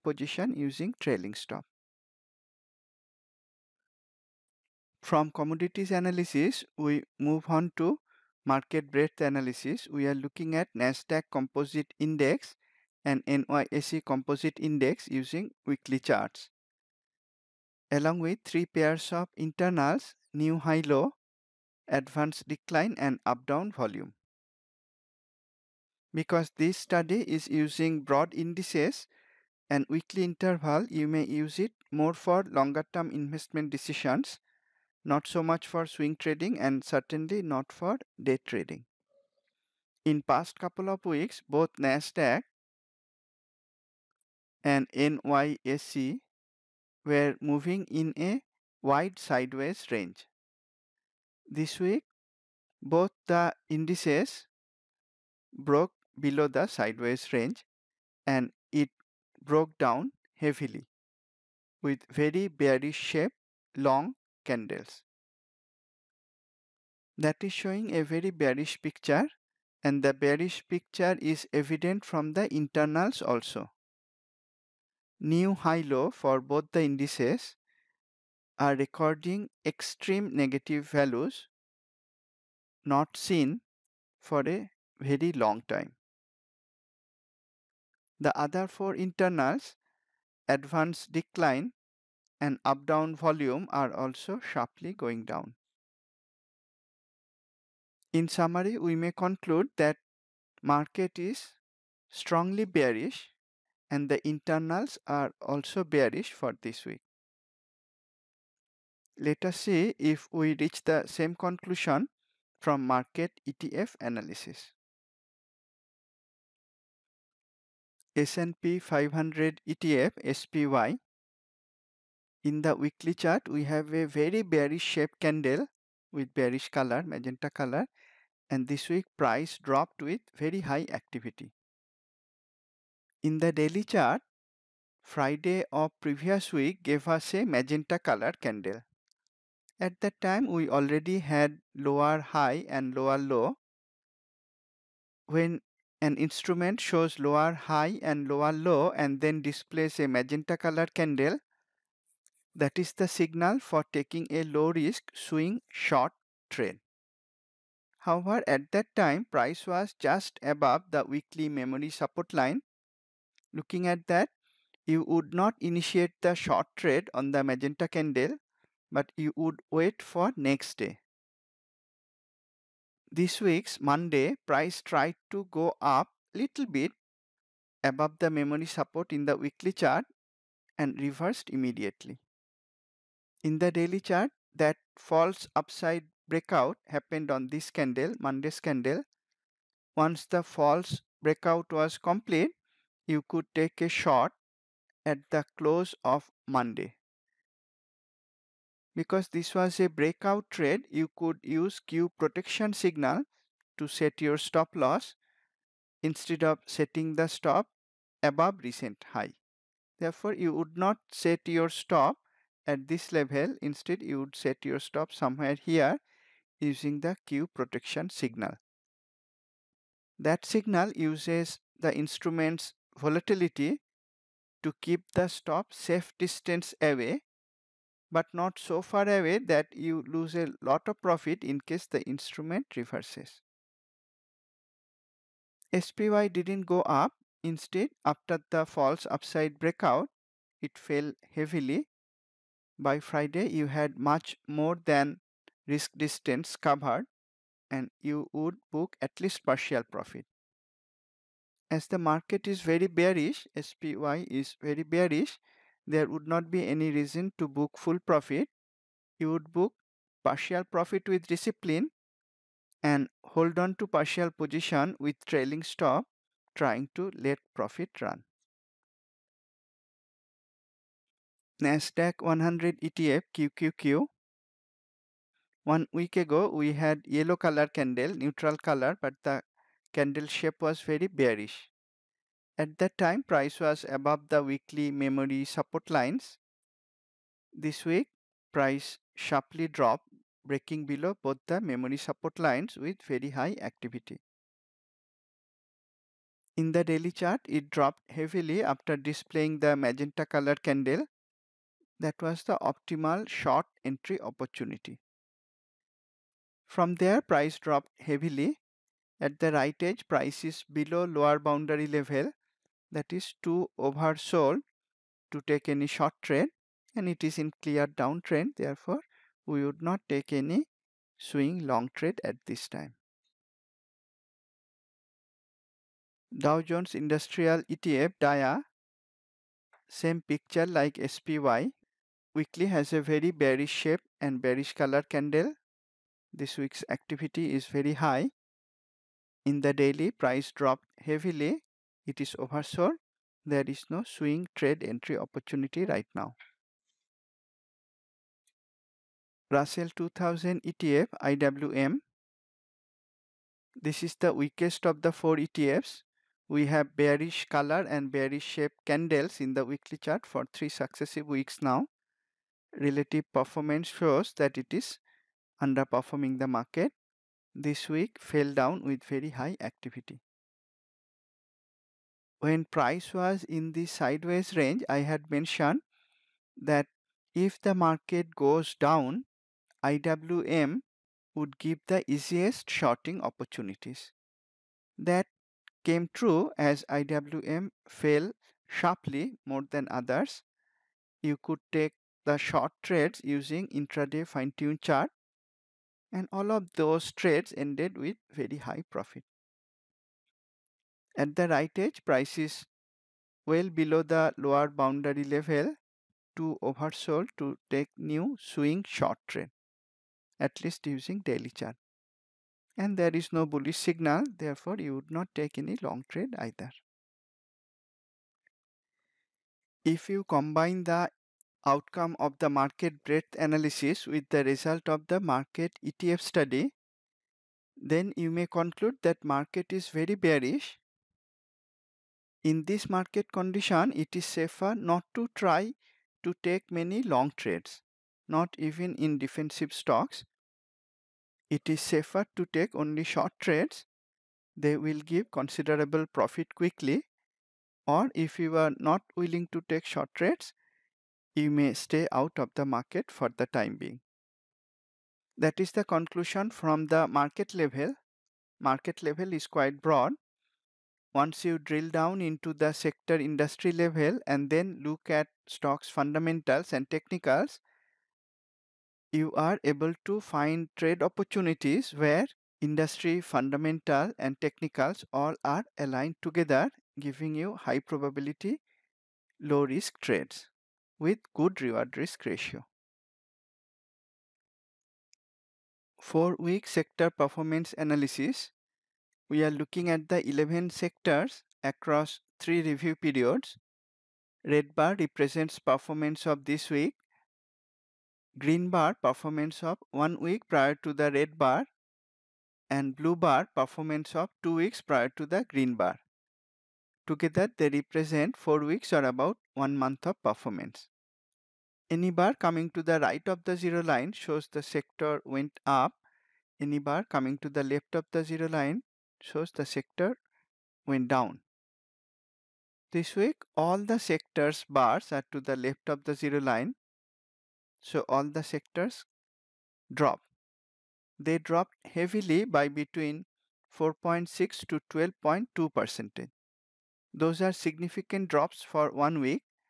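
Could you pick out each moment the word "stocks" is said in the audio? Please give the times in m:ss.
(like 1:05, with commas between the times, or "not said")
7:19, 7:45.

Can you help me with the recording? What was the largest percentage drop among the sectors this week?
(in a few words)
12.2 percent.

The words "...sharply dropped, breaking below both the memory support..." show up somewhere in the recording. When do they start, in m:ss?
4:49.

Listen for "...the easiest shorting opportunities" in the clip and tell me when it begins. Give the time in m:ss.
6:21.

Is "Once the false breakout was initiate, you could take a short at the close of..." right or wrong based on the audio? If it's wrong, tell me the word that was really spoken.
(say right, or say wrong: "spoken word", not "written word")
wrong: "complete", not "initiate".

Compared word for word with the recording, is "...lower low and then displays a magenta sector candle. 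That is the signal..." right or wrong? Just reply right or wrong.
wrong.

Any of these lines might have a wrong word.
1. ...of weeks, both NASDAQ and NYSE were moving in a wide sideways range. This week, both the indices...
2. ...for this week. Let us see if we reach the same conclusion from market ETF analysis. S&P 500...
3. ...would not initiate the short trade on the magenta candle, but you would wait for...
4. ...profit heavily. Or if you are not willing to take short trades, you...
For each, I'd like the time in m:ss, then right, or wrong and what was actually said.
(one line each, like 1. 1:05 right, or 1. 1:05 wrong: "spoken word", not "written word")
1. 0:40 right
2. 1:46 right
3. 2:45 right
4. 7:26 wrong: "quickly", not "heavily".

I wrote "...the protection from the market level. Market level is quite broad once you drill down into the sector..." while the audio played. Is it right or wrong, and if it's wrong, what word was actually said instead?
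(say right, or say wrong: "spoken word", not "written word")
wrong: "conclusion", not "protection".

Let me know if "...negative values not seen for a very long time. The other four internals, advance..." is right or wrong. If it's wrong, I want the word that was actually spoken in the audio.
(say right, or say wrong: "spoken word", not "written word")
right.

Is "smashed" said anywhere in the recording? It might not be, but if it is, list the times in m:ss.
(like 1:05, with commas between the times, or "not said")
not said.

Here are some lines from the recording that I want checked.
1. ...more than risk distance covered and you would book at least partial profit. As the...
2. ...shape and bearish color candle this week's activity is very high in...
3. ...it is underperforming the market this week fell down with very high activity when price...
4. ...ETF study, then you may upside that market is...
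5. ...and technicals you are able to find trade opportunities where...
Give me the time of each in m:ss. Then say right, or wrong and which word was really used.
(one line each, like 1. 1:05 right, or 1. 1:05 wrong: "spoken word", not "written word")
1. 4:04 right
2. 5:33 right
3. 6:04 right
4. 7:05 wrong: "conclude", not "upside"
5. 7:46 right.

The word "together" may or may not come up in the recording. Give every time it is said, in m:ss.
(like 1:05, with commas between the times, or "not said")
7:56, 8:27.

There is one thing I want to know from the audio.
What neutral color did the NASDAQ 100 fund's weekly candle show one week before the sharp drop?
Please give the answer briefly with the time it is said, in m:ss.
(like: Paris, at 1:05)
Yellow, at 4:37.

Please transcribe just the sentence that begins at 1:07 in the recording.
That is showing a very bearish picture and the bearish picture is evident from the internals also.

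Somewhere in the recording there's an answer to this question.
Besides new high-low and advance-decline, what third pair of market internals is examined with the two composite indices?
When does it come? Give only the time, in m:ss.
0:23.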